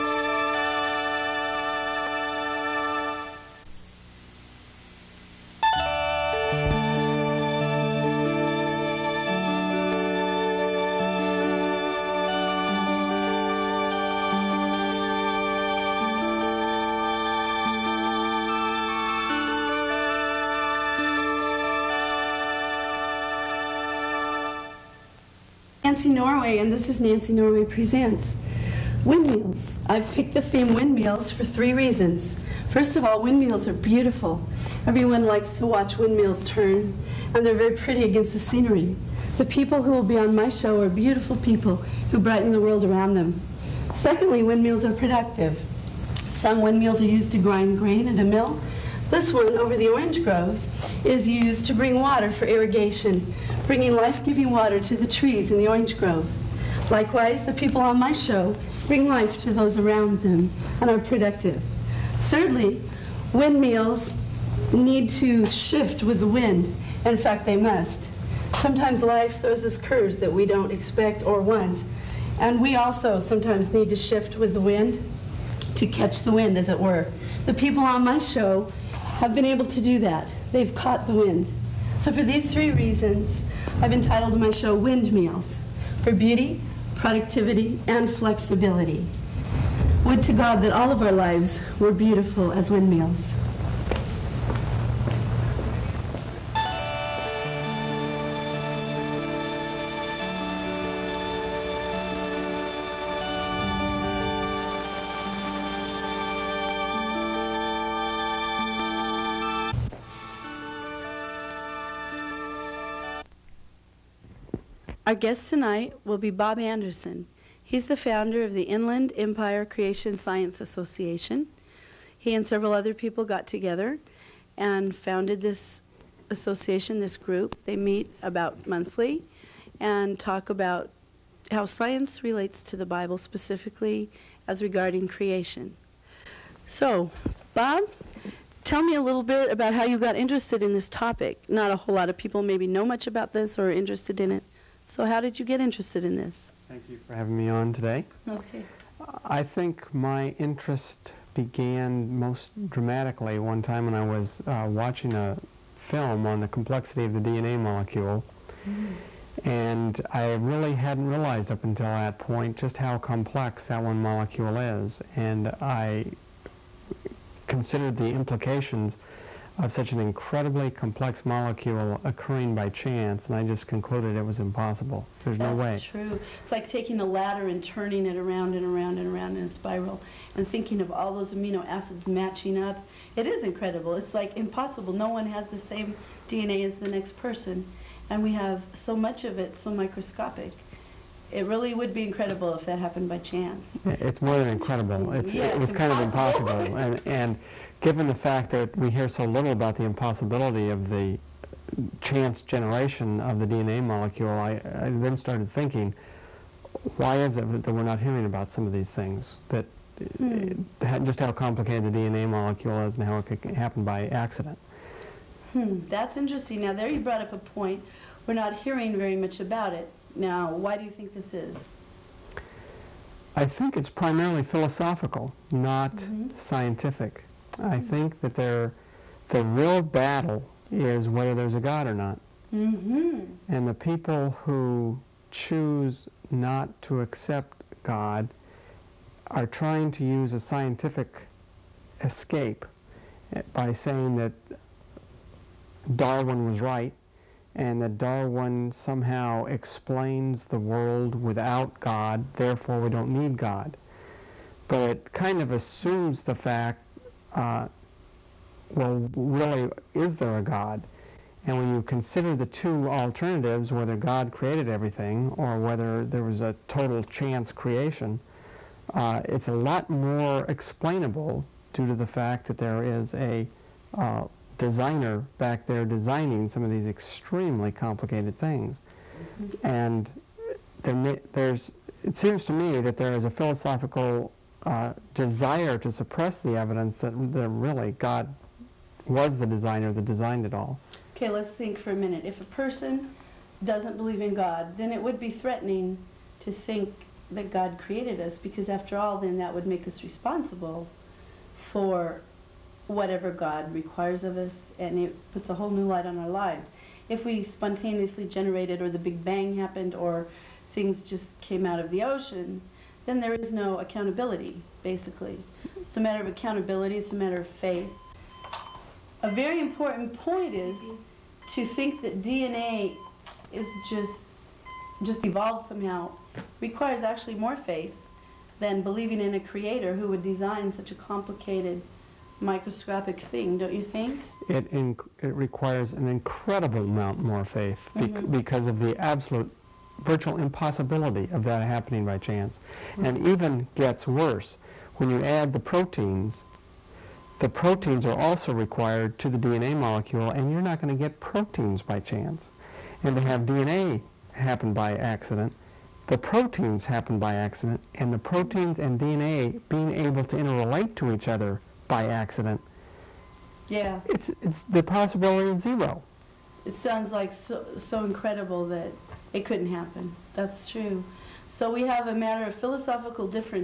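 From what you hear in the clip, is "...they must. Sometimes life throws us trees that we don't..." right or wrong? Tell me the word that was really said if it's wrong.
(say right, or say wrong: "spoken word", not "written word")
wrong: "curves", not "trees".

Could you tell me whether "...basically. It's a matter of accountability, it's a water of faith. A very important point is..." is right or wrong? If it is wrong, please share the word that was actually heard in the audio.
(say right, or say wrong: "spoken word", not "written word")
wrong: "matter", not "water".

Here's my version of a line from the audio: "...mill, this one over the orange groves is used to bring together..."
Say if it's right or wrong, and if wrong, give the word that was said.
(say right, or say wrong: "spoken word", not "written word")
wrong: "water", not "together".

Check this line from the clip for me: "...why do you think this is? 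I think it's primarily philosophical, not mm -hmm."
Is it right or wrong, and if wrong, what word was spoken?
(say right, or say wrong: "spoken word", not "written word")
right.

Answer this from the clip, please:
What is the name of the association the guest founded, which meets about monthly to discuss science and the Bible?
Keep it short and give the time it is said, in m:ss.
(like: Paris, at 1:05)
Inland Empire Creation Science Association, at 1:58.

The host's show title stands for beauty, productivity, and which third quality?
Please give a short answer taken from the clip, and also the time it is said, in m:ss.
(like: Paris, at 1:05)
Flexibility, at 1:28.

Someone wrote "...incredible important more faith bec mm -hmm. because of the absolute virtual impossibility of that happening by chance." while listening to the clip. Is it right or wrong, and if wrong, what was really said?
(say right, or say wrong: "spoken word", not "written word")
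wrong: "amount", not "important".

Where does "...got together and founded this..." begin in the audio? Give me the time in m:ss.
2:03.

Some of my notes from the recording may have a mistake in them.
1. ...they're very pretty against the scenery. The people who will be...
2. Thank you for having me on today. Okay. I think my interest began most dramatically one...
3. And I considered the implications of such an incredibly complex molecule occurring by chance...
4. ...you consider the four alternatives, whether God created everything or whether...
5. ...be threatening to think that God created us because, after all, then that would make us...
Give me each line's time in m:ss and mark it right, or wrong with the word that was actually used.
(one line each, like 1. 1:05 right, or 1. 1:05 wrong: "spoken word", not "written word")
1. 0:37 right
2. 2:26 right
3. 2:45 right
4. 4:21 wrong: "two", not "four"
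5. 4:55 right.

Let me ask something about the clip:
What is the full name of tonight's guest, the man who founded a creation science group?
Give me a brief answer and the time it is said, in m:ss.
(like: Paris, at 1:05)
Bob Andersen, at 1:56.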